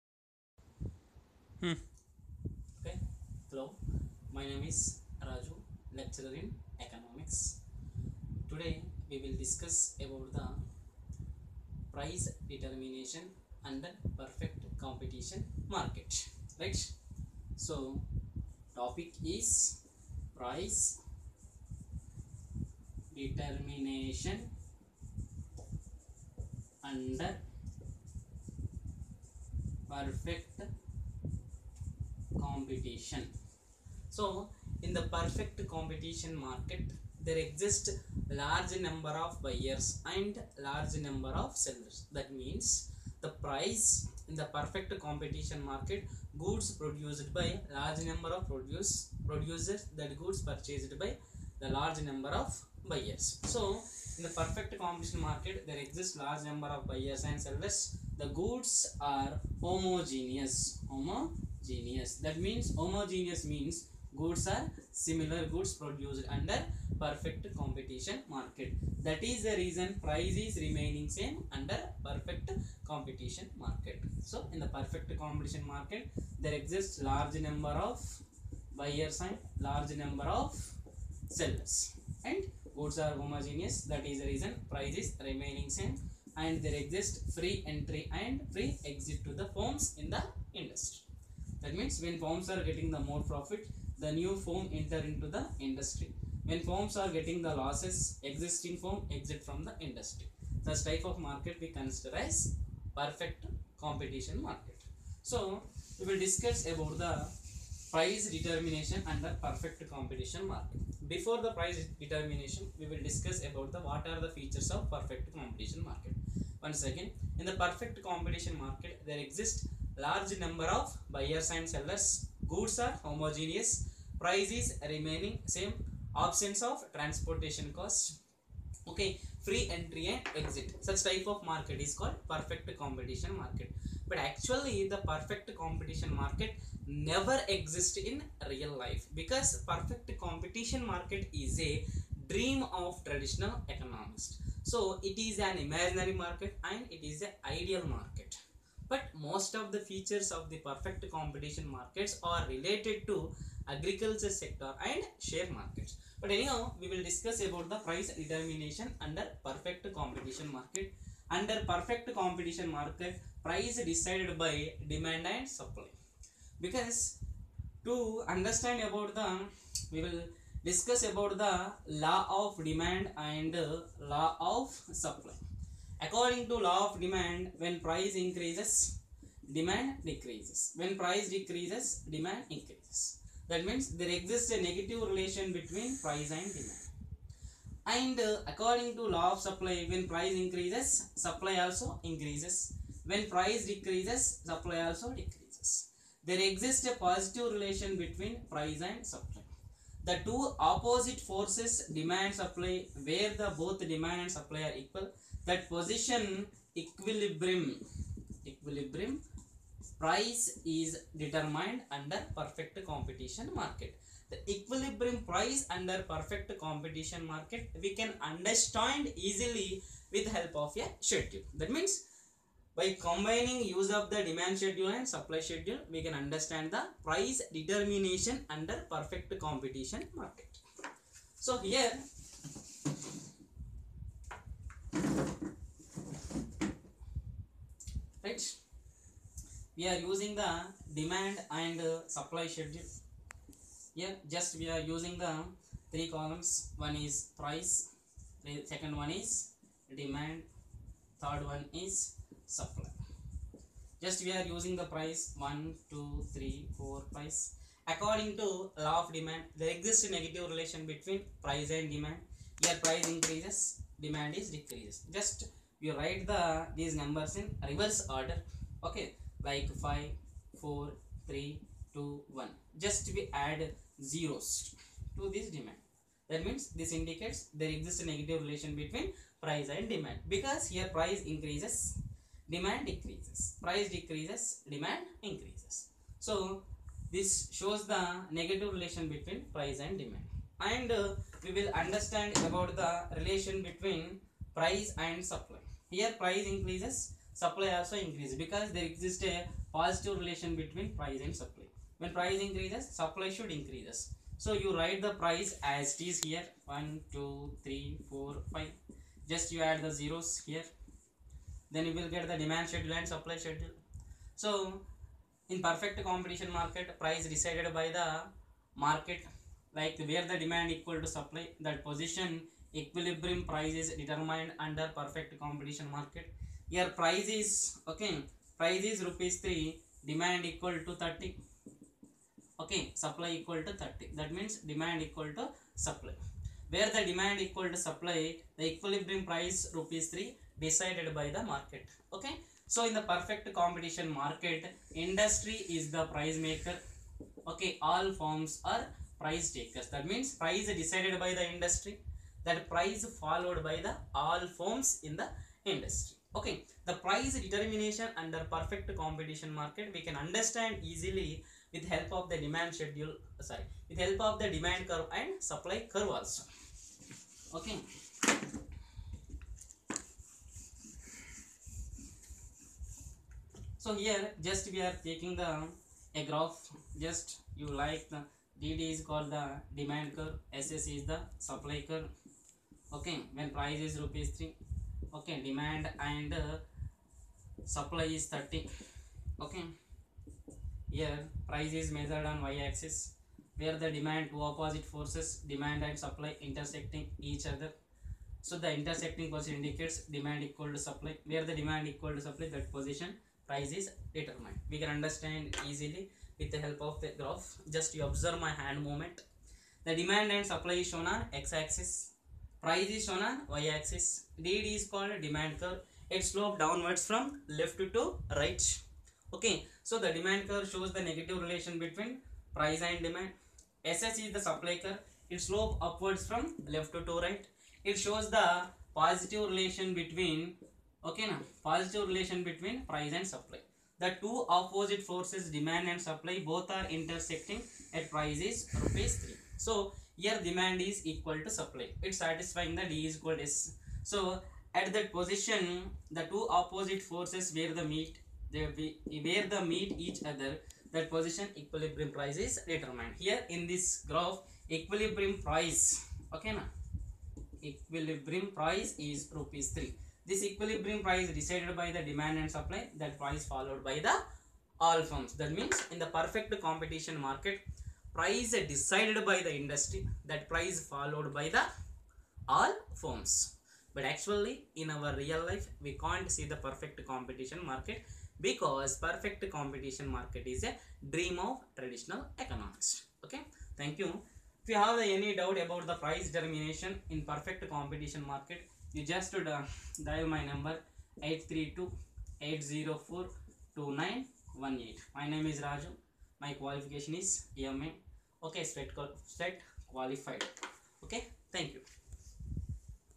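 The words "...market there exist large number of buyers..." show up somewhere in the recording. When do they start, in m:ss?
0:36.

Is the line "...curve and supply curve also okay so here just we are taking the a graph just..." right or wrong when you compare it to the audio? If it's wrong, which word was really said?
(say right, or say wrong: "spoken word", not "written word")
right.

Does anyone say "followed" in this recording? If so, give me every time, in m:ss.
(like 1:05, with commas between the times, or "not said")
5:53, 7:43, 7:50.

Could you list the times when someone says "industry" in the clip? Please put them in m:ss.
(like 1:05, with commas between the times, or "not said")
1:30, 1:35, 1:39, 5:45, 5:51, 5:55, 7:49.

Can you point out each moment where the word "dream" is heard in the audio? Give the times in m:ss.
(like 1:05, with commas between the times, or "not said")
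2:22, 8:01.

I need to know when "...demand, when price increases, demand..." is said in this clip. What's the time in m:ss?
2:56.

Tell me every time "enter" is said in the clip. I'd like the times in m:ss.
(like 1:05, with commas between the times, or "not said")
1:34.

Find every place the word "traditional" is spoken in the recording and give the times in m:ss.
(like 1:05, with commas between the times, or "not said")
2:23, 8:01.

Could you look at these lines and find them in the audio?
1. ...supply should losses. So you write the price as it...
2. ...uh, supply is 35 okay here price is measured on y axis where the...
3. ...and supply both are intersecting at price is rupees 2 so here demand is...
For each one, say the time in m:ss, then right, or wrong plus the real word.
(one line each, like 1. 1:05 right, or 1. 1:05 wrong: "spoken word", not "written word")
1. 5:02 wrong: "increases", not "losses"
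2. 6:26 wrong: "30", not "35"
3. 7:15 wrong: "3", not "2".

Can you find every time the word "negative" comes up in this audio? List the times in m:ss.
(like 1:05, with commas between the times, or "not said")
3:04, 4:20, 4:38, 4:48, 7:01.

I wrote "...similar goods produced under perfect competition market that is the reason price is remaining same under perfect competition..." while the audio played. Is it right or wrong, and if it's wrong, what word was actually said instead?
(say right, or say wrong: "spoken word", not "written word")
right.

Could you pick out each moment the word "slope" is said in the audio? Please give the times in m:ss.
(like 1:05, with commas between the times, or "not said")
6:56, 7:05.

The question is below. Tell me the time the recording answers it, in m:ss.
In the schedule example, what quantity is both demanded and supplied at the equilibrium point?
5:30.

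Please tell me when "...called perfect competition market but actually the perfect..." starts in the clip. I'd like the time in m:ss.
2:11.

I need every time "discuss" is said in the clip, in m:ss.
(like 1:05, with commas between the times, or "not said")
0:09, 1:46, 1:53, 2:37, 2:50.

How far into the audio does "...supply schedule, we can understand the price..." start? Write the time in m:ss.
3:45.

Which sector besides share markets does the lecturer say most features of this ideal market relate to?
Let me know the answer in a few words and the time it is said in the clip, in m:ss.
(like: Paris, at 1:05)
agriculture, at 2:33.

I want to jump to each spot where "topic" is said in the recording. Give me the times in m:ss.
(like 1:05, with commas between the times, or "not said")
0:18.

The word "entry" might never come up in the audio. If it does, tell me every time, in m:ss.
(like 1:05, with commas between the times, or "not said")
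1:27, 2:09.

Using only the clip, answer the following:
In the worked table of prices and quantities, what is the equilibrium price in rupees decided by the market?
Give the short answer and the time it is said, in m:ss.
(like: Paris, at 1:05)
3, at 5:39.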